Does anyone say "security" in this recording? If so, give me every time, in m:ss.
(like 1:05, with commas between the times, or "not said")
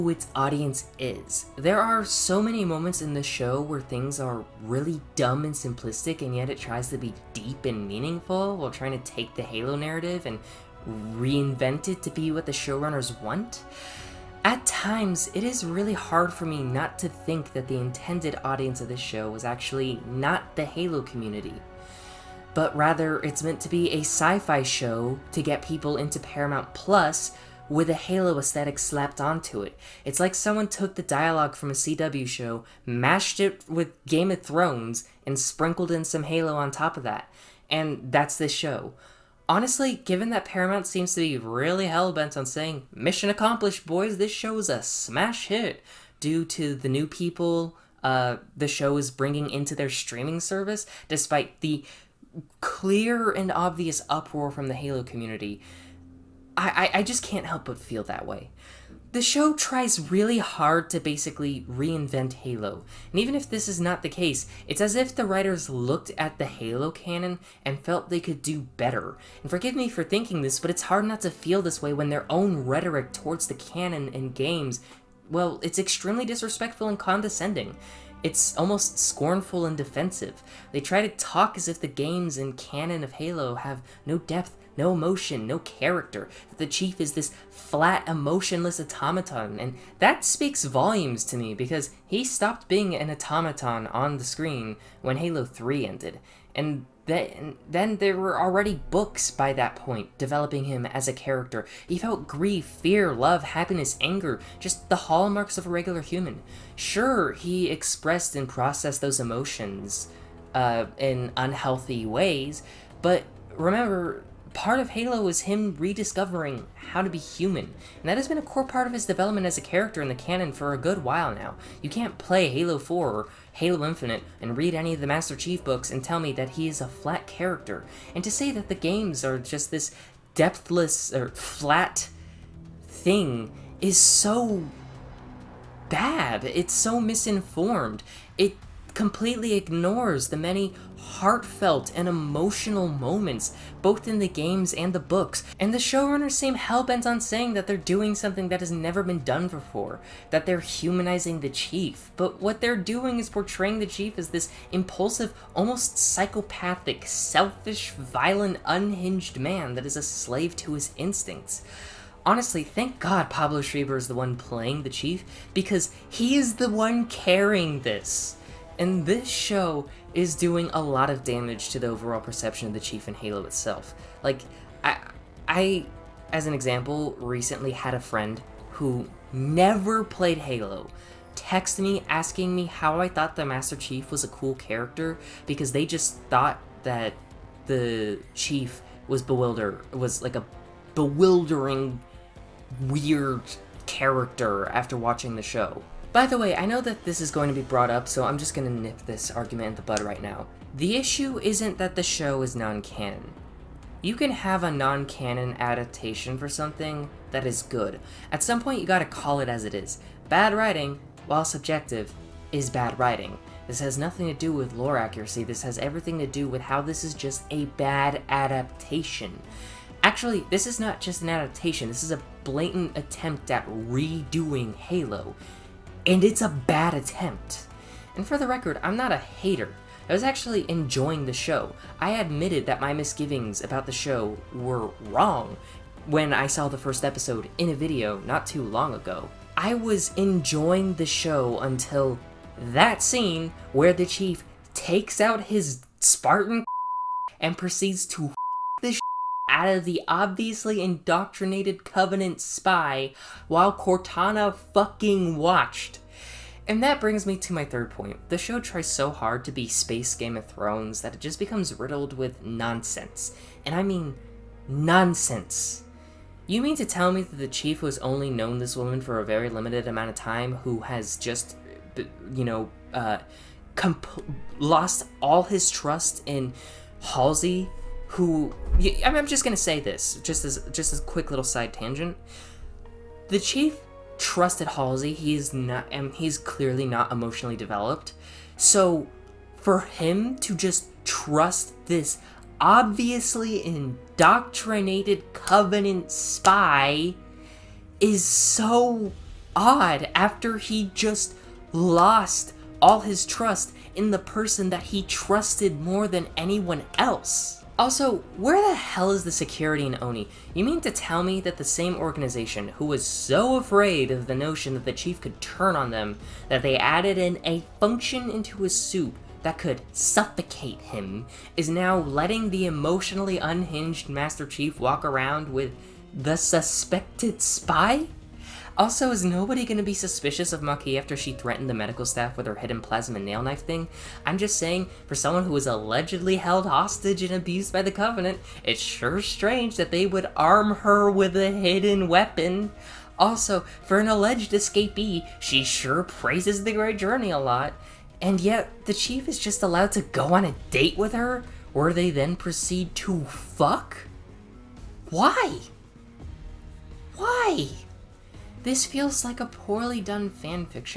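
5:09.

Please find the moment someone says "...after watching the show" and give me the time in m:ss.
3:14.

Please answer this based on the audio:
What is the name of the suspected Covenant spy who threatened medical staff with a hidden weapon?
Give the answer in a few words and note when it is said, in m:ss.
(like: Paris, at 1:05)
Makee, at 5:30.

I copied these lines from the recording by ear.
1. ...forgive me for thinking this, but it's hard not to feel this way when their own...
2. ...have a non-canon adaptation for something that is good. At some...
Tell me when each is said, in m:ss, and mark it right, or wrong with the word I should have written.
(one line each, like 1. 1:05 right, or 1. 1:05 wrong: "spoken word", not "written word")
1. 1:09 right
2. 3:24 right.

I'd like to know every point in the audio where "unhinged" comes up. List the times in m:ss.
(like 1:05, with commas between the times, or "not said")
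2:38, 5:23.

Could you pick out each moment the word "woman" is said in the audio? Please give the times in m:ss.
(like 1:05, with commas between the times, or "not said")
4:28.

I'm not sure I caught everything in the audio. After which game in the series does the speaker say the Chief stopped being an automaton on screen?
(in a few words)
Halo 3.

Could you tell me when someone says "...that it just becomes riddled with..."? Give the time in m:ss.
4:21.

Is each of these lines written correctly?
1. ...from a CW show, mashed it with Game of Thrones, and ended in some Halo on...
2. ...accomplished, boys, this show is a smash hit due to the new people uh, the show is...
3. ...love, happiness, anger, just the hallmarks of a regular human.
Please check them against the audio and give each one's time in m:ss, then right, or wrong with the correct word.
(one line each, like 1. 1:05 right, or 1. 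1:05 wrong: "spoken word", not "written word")
1. 0:31 wrong: "sprinkled", not "ended"
2. 0:43 right
3. 1:43 right.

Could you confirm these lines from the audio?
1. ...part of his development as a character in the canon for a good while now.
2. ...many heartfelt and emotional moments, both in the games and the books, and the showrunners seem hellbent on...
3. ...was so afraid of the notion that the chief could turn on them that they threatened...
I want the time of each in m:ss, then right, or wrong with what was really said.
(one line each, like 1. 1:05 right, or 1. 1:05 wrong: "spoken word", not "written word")
1. 1:58 right
2. 2:20 right
3. 5:12 wrong: "added", not "threatened".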